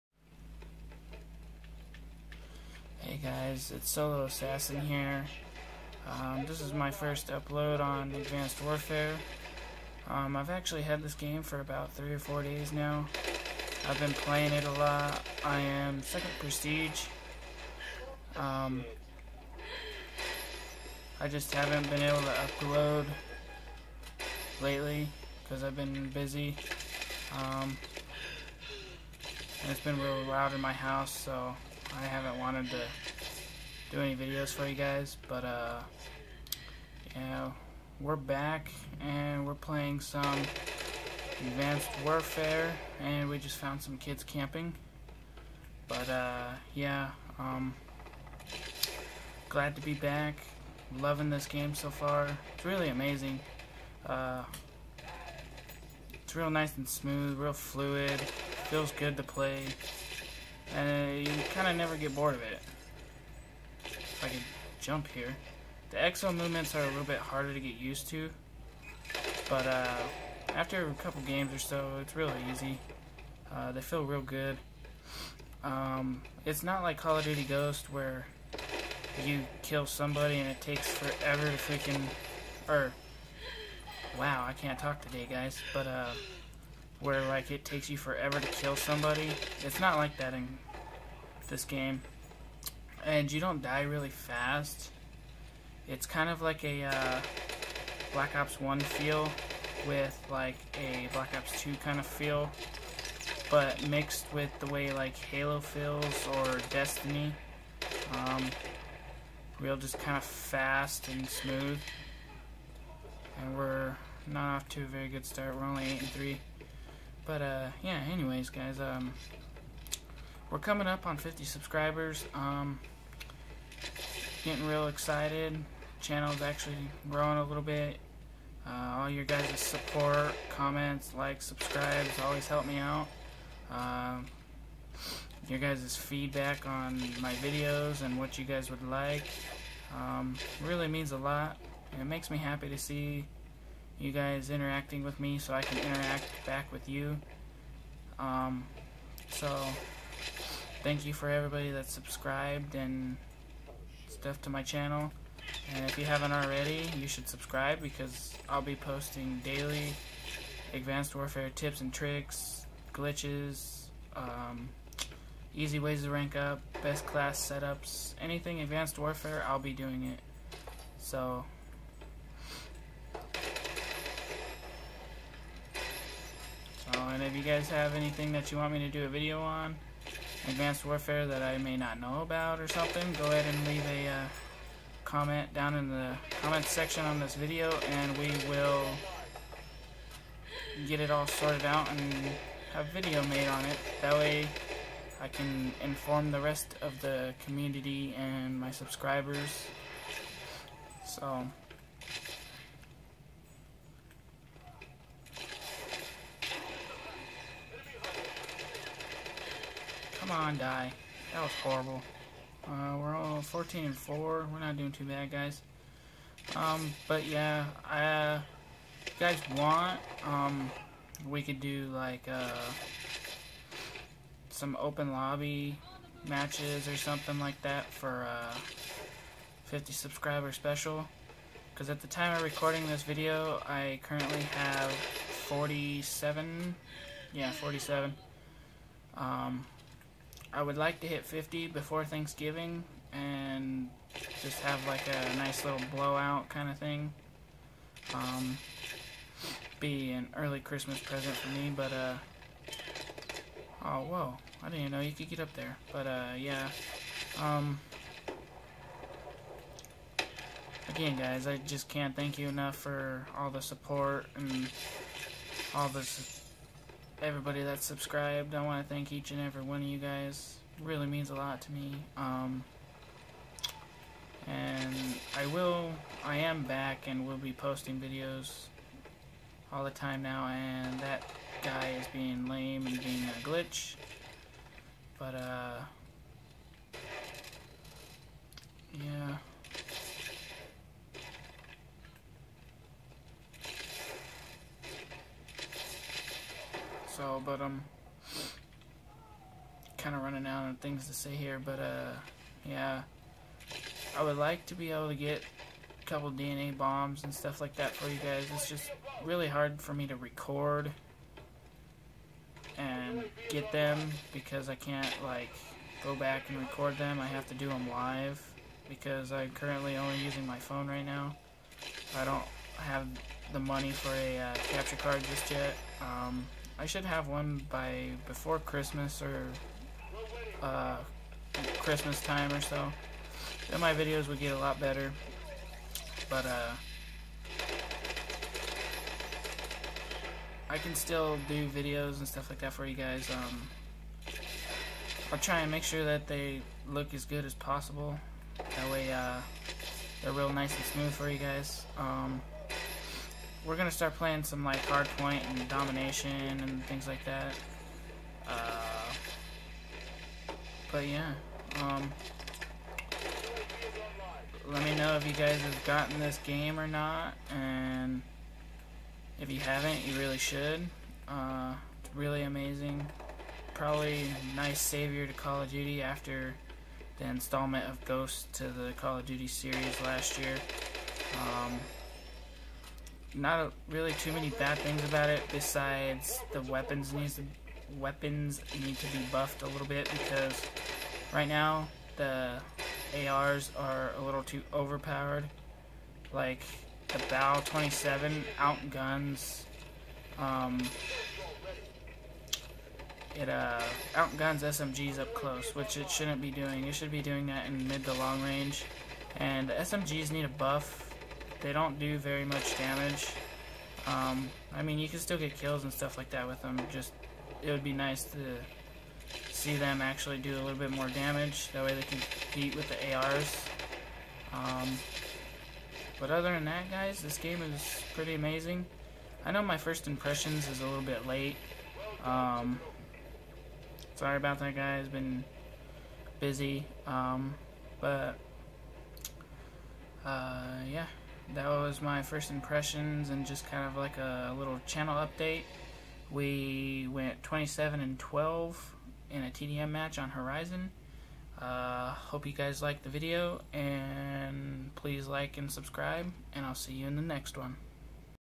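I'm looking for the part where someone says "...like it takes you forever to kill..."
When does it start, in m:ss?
1:27.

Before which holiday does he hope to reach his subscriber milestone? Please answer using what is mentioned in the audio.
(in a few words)
Thanksgiving.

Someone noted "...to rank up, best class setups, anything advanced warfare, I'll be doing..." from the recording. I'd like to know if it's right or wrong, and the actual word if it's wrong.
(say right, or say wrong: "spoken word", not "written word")
right.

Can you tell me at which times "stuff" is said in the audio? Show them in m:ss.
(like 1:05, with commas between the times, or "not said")
2:34, 5:07, 5:42, 6:55.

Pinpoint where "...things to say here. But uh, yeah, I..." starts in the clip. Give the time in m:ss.
5:00.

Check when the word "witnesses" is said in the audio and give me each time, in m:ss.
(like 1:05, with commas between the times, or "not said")
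not said.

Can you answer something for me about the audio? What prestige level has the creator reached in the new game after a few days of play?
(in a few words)
Second prestige.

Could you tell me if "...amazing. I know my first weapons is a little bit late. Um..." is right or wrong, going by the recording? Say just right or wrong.
wrong.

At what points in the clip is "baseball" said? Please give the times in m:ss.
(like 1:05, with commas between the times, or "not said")
not said.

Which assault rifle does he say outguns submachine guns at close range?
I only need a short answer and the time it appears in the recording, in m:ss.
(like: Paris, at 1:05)
Bal-27, at 6:37.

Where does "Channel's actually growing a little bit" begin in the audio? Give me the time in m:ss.
2:05.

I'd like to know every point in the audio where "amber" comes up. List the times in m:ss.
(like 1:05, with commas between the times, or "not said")
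not said.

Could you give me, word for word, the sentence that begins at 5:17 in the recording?
I have to do them live because I'm currently only using my phone right now.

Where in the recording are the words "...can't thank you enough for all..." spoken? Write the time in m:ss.
4:21.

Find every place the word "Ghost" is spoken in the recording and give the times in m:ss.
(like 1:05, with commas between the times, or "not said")
1:17, 6:18.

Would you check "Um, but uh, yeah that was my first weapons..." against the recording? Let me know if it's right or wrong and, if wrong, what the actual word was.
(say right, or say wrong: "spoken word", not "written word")
wrong: "impressions", not "weapons".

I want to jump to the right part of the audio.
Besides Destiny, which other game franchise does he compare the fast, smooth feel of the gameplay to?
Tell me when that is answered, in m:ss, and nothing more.
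1:45.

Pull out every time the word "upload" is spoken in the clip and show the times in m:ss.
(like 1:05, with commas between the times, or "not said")
0:07, 0:22.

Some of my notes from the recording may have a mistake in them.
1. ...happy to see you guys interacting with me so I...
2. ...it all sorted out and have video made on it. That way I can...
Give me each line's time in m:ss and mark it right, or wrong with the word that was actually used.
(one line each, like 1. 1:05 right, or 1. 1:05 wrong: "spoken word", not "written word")
1. 2:22 right
2. 3:10 right.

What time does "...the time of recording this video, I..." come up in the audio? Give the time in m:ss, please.
3:51.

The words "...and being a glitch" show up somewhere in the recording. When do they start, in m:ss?
4:42.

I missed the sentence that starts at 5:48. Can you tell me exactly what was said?
That way uh, they're real nice and smooth for you guys.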